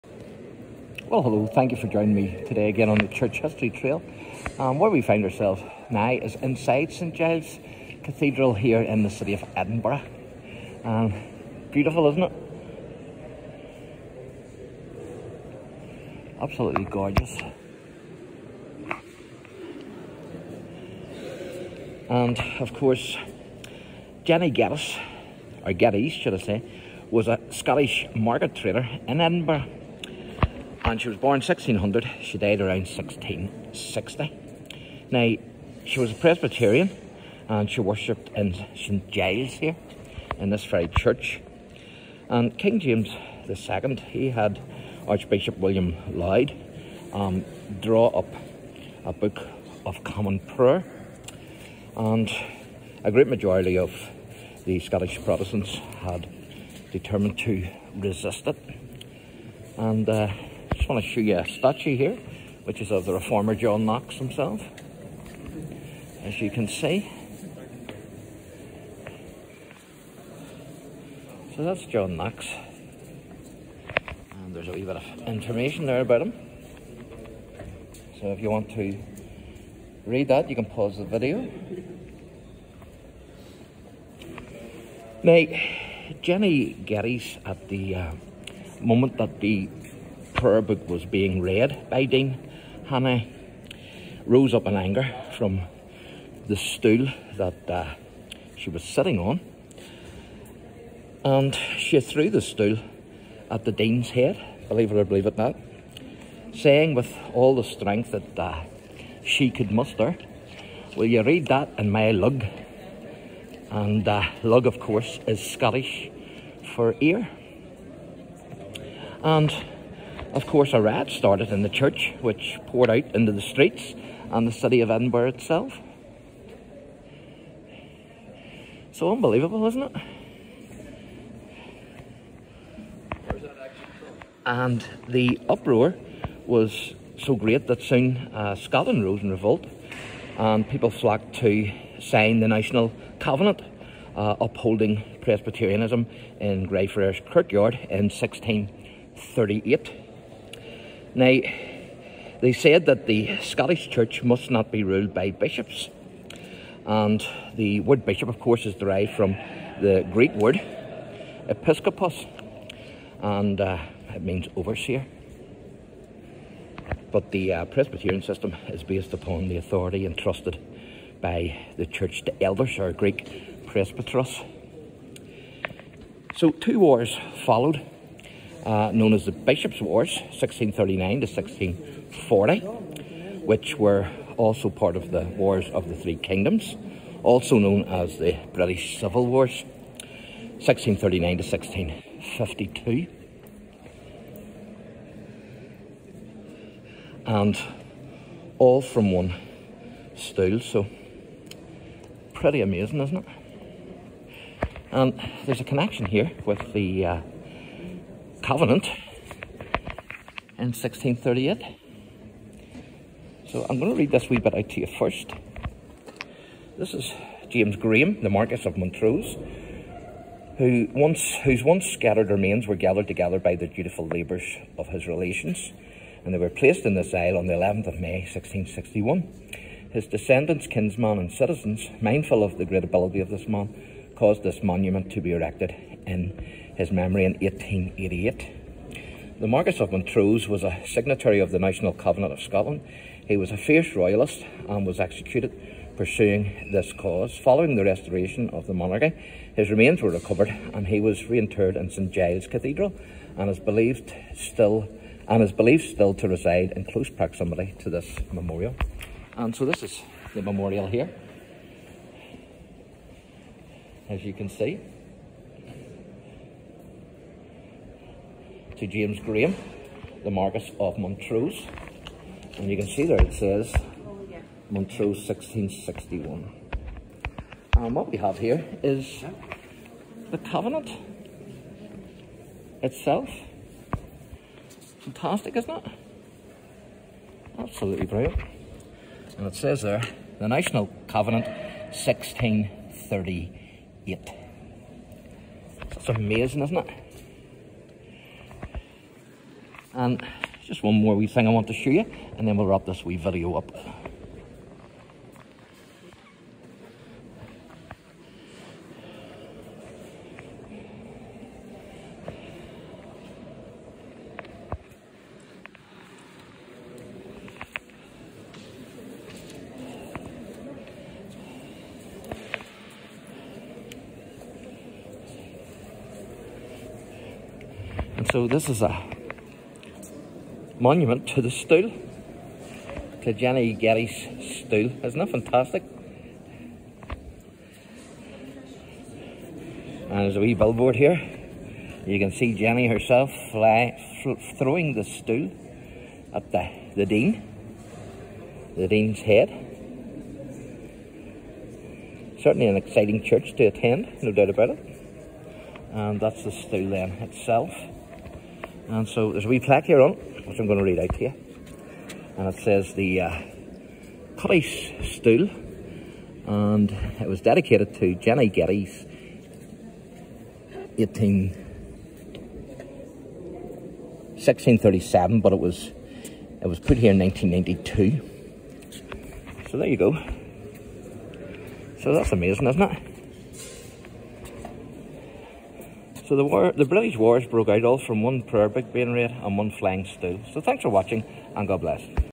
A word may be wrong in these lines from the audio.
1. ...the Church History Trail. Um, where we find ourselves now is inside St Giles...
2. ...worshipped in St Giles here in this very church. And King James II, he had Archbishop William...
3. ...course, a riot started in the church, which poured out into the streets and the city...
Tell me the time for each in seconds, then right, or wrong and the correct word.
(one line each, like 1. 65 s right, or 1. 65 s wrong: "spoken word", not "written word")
1. 2 s right
2. 37 s right
3. 120 s right.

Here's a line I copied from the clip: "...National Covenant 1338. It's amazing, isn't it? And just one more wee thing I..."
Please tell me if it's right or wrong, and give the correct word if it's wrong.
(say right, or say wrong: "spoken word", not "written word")
wrong: "1638", not "1338".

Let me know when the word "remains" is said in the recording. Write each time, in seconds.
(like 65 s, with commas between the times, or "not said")
222 s, 249 s.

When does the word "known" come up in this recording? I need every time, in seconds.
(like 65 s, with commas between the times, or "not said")
178 s, 187 s.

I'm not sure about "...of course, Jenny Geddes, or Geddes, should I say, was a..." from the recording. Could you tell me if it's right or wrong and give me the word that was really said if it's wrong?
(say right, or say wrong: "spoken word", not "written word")
right.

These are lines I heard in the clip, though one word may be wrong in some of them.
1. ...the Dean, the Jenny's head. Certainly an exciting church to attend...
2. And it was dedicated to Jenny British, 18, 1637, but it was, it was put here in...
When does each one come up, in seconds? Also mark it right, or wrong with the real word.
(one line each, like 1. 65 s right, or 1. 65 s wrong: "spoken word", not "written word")
1. 346 s wrong: "Dean", not "Jenny"
2. 366 s wrong: "Geddes", not "British".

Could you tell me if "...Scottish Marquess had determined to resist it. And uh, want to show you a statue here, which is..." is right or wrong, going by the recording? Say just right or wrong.
wrong.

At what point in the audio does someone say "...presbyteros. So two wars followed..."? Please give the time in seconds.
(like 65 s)
173 s.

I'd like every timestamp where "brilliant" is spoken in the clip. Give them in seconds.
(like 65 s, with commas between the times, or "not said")
288 s.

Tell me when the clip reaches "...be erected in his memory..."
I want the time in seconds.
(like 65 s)
235 s.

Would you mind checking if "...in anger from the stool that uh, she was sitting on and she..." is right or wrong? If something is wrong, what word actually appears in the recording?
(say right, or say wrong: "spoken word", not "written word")
right.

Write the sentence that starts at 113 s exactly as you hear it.
And uh, lug, of course, is Scottish for ear.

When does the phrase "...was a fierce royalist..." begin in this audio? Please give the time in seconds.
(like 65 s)
243 s.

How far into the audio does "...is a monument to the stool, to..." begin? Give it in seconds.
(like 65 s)
328 s.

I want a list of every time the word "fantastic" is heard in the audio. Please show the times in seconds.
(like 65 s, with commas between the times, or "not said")
285 s, 335 s.